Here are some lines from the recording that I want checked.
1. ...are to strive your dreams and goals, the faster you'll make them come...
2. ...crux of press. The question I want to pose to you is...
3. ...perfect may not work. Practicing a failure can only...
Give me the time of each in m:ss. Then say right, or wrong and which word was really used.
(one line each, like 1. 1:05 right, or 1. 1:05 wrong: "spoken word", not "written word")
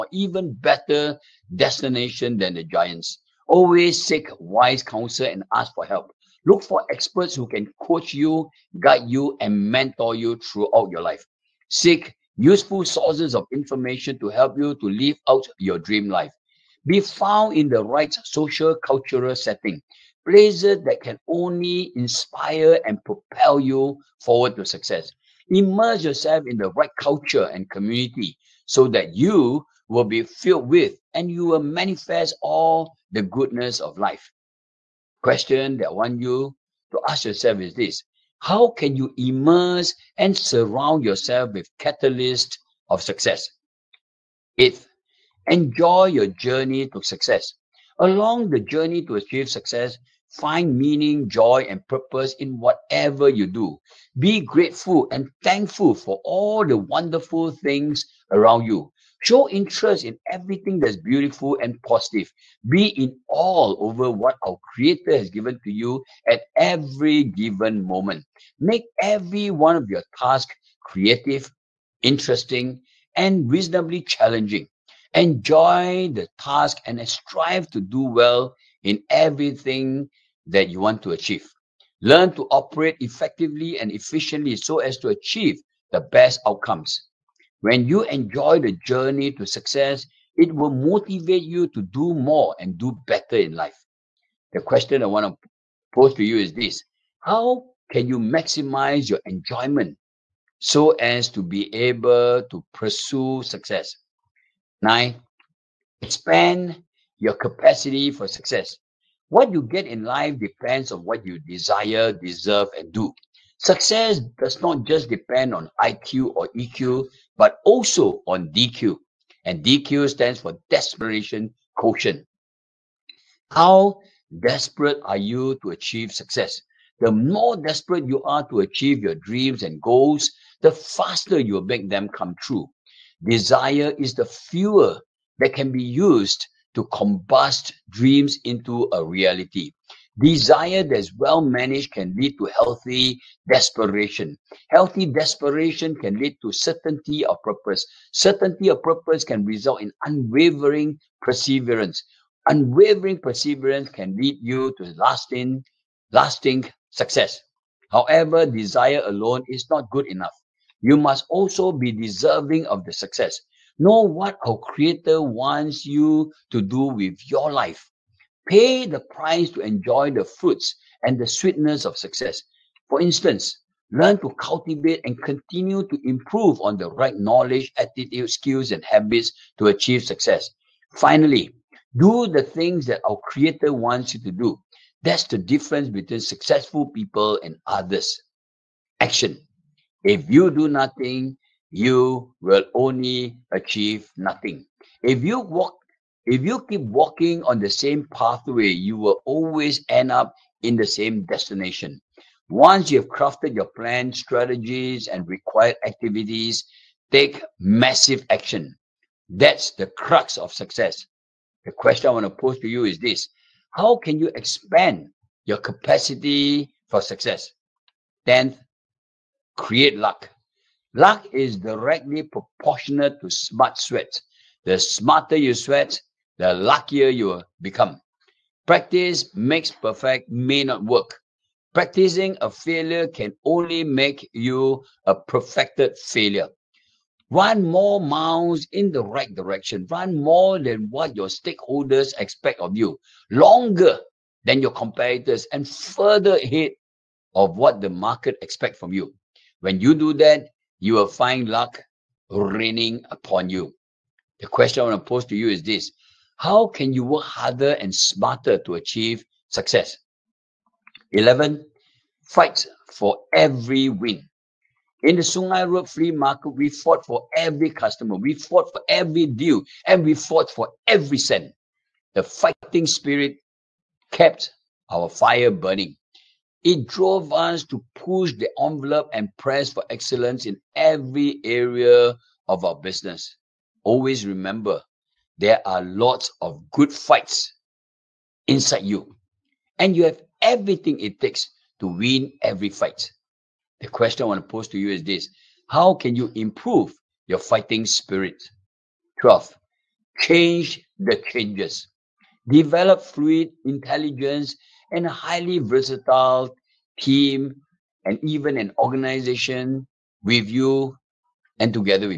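1. 2:08 wrong: "achieve", not "strive"
2. 3:29 wrong: "success", not "press"
3. 3:49 right.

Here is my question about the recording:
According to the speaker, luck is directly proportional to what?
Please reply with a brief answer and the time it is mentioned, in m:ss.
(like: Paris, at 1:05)
Smart sweat, at 3:43.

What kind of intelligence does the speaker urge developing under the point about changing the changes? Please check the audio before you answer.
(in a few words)
Fluid intelligence.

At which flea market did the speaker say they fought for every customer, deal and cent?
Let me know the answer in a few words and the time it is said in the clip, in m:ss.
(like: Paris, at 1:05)
Sungai Road, at 4:25.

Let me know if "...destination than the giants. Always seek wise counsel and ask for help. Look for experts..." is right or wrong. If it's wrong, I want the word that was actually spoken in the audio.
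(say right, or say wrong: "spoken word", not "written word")
right.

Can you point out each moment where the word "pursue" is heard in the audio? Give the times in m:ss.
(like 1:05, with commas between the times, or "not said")
1:42.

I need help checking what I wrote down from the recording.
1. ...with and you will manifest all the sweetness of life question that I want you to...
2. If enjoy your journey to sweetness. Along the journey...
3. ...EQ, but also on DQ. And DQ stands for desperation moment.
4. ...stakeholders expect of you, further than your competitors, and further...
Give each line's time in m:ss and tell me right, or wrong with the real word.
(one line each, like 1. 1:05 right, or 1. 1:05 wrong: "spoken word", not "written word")
1. 0:30 wrong: "goodness", not "sweetness"
2. 0:44 wrong: "success", not "sweetness"
3. 1:56 wrong: "quotient", not "moment"
4. 4:01 wrong: "longer", not "further".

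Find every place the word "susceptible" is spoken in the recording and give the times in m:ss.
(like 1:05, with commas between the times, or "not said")
not said.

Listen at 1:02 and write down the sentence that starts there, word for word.
Be in awe over what our Creator has given to you at every given moment.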